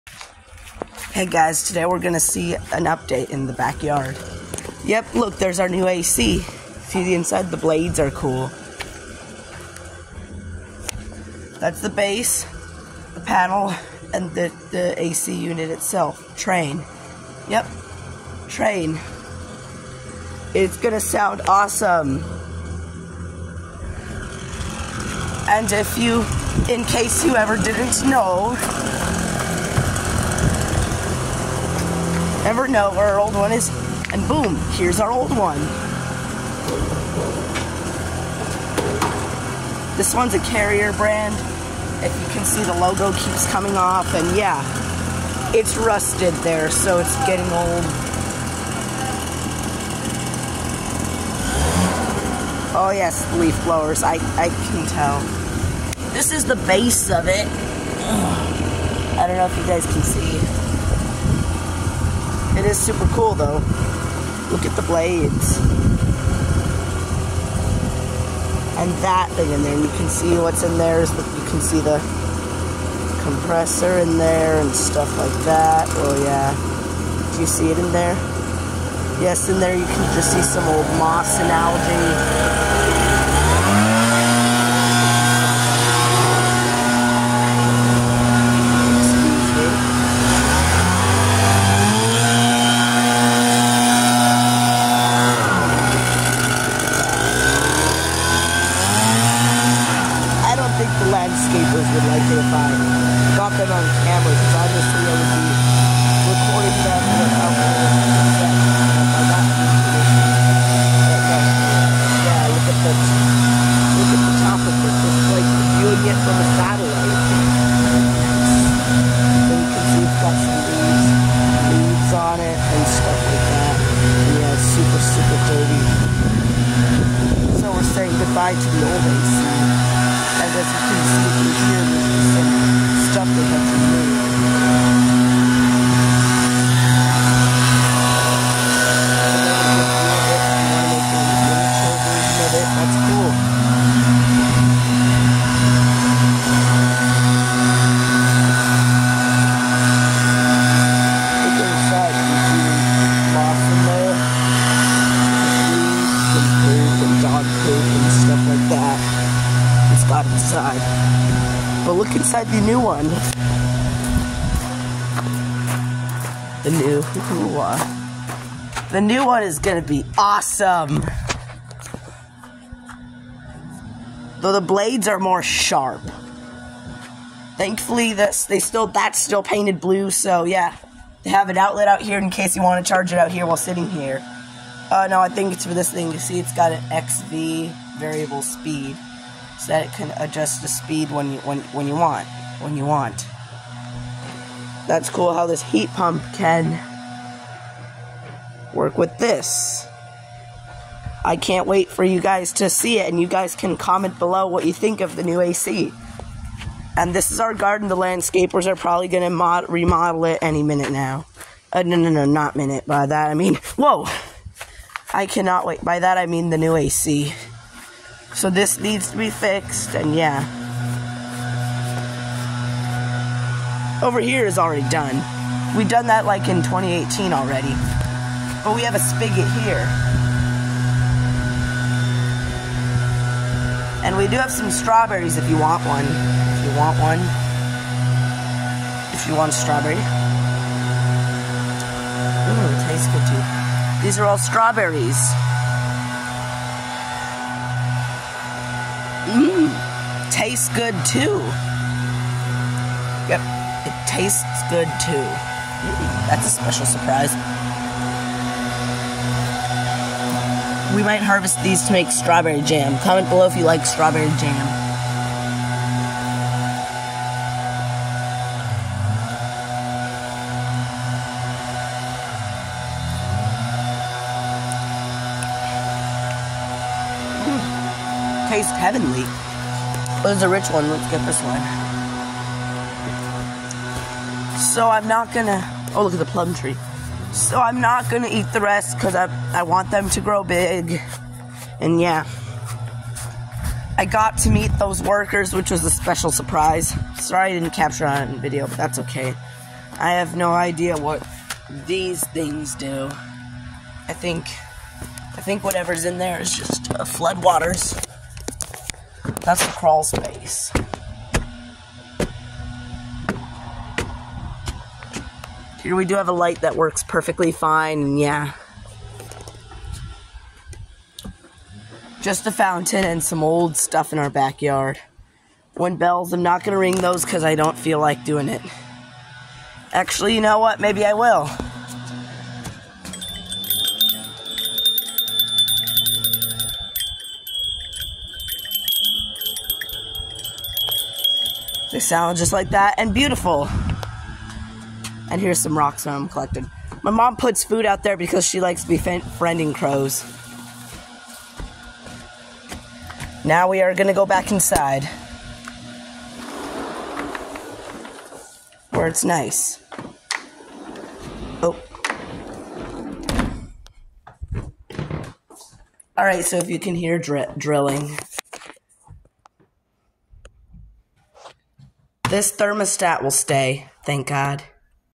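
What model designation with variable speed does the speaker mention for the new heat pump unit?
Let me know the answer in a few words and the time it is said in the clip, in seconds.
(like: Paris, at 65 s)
XV, at 187 s.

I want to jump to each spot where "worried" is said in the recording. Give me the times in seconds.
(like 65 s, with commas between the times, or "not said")
not said.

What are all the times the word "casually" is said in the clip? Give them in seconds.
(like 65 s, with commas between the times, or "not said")
not said.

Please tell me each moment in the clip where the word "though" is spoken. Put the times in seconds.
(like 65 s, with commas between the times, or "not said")
63 s, 174 s.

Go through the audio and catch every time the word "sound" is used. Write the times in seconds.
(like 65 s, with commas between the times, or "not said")
21 s, 341 s.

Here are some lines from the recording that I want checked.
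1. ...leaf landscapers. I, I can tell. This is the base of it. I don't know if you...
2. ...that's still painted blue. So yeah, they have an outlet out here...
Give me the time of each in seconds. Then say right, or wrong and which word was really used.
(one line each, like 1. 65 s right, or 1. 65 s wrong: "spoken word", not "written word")
1. 53 s wrong: "blowers", not "landscapers"
2. 178 s right.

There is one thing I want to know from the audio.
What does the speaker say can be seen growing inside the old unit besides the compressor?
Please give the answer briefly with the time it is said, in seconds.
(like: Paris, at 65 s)
moss and algae, at 80 s.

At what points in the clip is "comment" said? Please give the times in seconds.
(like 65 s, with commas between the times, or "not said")
203 s, 262 s.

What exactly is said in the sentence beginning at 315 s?
Here we do have a light that works perfectly fine, yeah.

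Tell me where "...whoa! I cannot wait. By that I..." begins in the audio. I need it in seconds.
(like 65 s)
213 s.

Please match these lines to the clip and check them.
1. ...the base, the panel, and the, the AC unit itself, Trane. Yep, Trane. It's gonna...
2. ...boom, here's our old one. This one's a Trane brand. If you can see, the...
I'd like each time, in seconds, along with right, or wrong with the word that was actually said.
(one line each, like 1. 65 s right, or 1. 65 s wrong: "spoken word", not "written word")
1. 11 s right
2. 34 s wrong: "Carrier", not "Trane".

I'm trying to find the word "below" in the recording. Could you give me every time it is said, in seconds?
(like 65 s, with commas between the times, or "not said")
204 s, 263 s.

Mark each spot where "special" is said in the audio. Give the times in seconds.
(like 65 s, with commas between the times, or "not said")
256 s, 295 s.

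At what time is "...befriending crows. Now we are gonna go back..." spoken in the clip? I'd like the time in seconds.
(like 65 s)
348 s.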